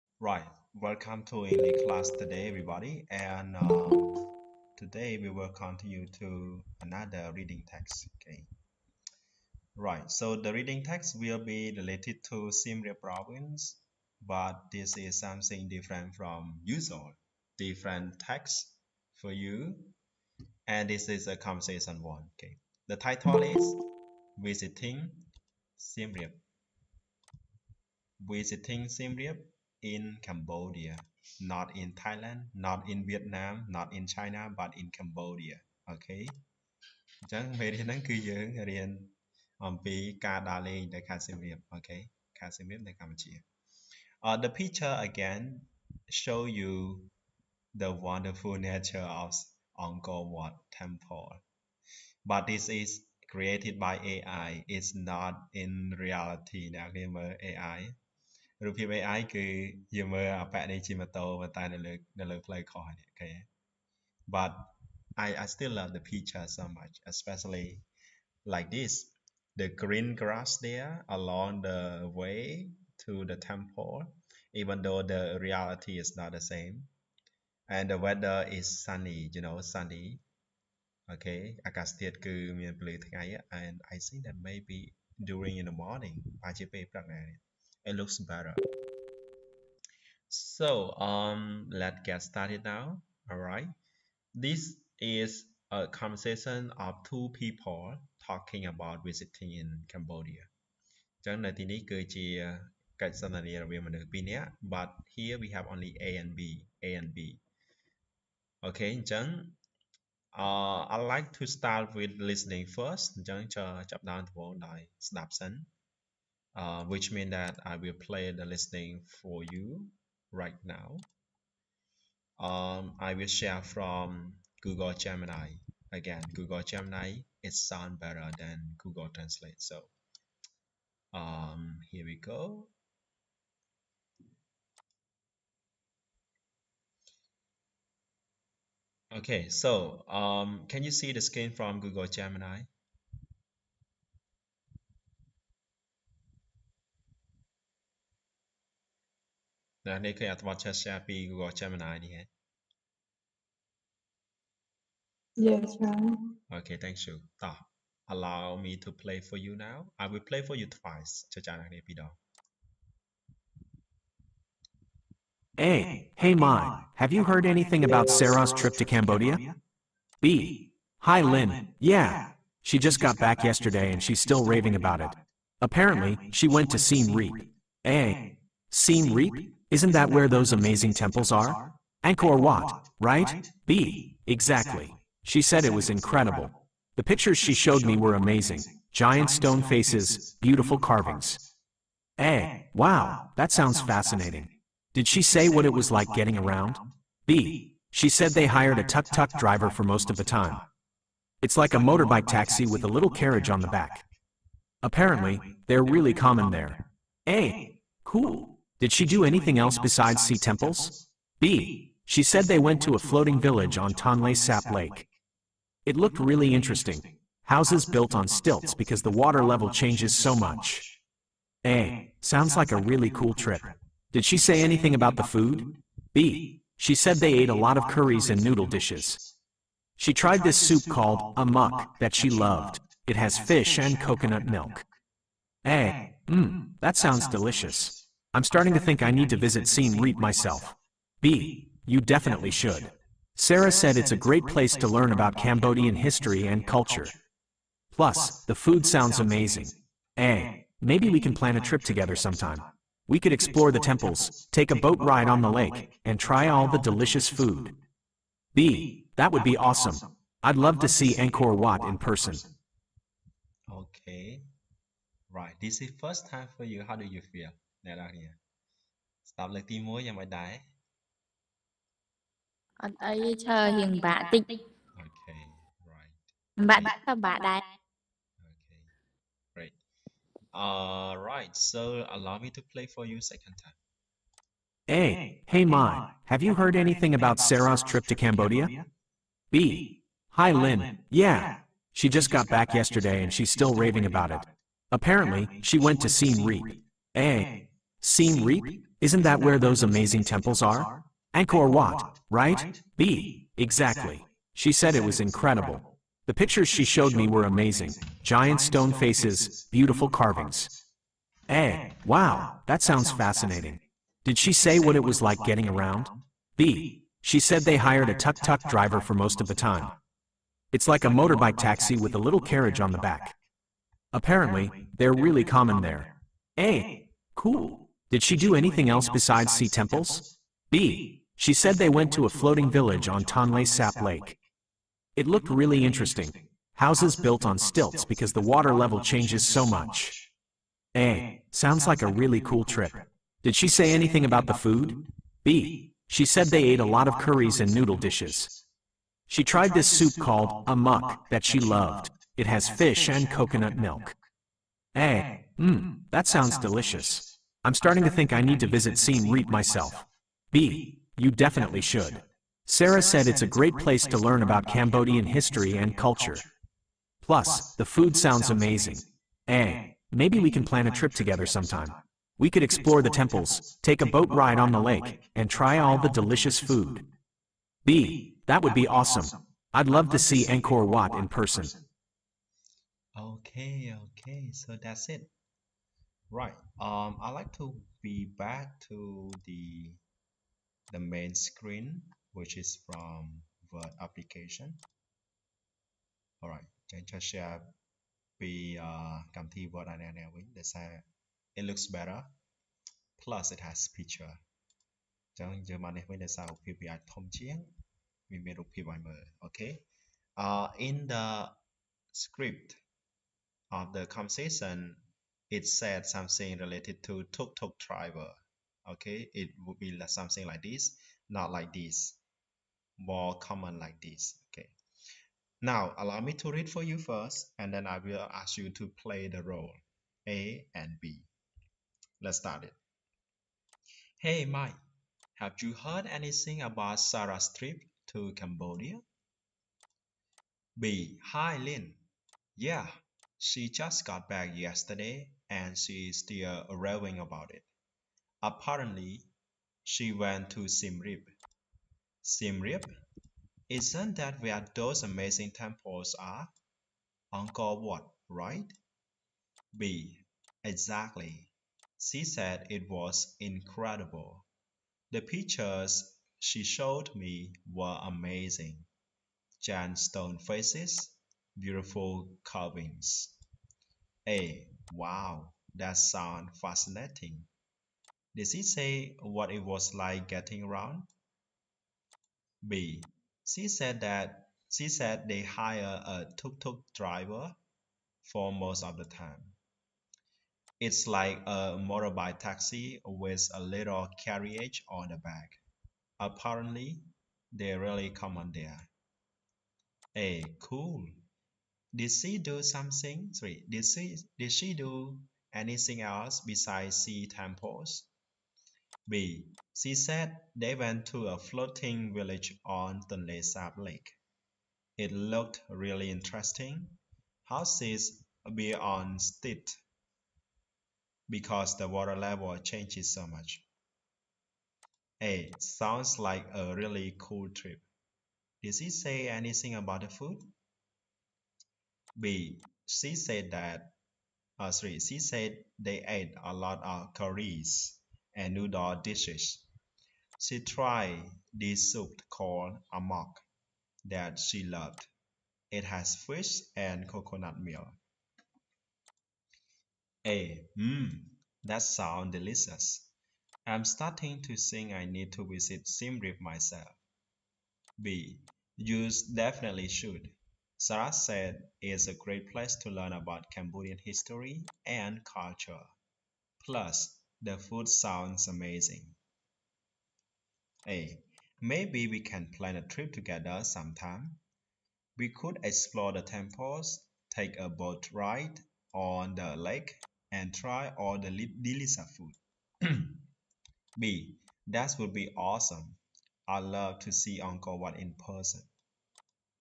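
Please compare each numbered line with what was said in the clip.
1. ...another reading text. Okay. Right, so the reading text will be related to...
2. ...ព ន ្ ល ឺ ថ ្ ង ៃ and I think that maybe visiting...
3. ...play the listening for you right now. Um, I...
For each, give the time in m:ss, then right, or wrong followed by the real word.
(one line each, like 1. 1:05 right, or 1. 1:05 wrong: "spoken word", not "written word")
1. 0:06 right
2. 1:22 wrong: "during", not "visiting"
3. 1:57 right.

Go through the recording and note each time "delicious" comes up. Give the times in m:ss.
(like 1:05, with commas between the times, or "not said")
3:57, 4:16, 5:56, 6:16, 9:12, 9:41.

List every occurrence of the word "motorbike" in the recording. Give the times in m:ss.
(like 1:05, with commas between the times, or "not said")
3:21, 5:21, 8:11.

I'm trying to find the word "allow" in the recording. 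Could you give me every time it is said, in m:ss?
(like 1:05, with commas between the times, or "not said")
2:38, 4:42, 7:05.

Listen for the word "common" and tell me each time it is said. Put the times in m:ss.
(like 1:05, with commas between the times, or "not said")
3:26, 5:25, 7:03.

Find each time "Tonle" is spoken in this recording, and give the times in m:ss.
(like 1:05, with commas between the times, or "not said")
3:33, 5:33.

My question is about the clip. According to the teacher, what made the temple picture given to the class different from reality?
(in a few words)
Created by AI.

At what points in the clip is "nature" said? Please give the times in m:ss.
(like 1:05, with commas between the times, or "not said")
0:48.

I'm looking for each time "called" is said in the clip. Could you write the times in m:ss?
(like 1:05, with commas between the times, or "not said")
3:50, 5:50, 9:02.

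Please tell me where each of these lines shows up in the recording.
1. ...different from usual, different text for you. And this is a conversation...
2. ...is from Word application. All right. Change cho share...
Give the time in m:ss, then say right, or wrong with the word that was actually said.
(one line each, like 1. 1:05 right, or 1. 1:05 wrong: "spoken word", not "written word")
1. 0:15 right
2. 6:32 right.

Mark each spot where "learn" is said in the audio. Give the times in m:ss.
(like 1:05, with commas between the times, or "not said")
4:04, 6:04, 9:22.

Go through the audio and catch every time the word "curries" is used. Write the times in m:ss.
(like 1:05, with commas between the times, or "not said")
3:47, 5:47, 8:57.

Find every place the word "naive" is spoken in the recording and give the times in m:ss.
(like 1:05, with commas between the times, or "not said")
not said.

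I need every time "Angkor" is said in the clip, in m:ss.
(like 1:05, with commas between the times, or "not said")
0:49, 3:02, 4:21, 5:01, 6:20, 7:37, 9:47.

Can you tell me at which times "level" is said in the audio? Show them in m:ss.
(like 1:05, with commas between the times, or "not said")
3:39, 5:38, 8:42.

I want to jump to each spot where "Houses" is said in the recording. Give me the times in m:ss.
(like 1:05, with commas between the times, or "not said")
3:37, 5:36, 8:37.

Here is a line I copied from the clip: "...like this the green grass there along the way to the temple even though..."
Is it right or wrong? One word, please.
right.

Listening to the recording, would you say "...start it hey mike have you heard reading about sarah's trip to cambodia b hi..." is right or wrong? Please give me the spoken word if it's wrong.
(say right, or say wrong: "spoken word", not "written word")
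wrong: "anything", not "reading".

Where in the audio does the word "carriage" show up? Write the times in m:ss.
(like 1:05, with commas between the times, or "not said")
3:23, 5:22, 8:14.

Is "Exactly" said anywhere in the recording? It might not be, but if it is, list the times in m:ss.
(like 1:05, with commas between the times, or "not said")
3:04, 5:03, 7:40.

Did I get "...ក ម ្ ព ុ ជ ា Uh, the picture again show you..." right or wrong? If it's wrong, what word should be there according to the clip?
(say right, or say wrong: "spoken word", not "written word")
right.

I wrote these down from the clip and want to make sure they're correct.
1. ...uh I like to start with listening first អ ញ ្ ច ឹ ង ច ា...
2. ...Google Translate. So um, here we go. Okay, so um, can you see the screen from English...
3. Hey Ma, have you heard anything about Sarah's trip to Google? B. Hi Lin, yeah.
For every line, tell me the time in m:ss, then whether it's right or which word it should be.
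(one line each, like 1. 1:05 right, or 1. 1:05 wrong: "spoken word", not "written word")
1. 1:50 right
2. 2:08 wrong: "Google", not "English"
3. 4:45 wrong: "Cambodia", not "Google".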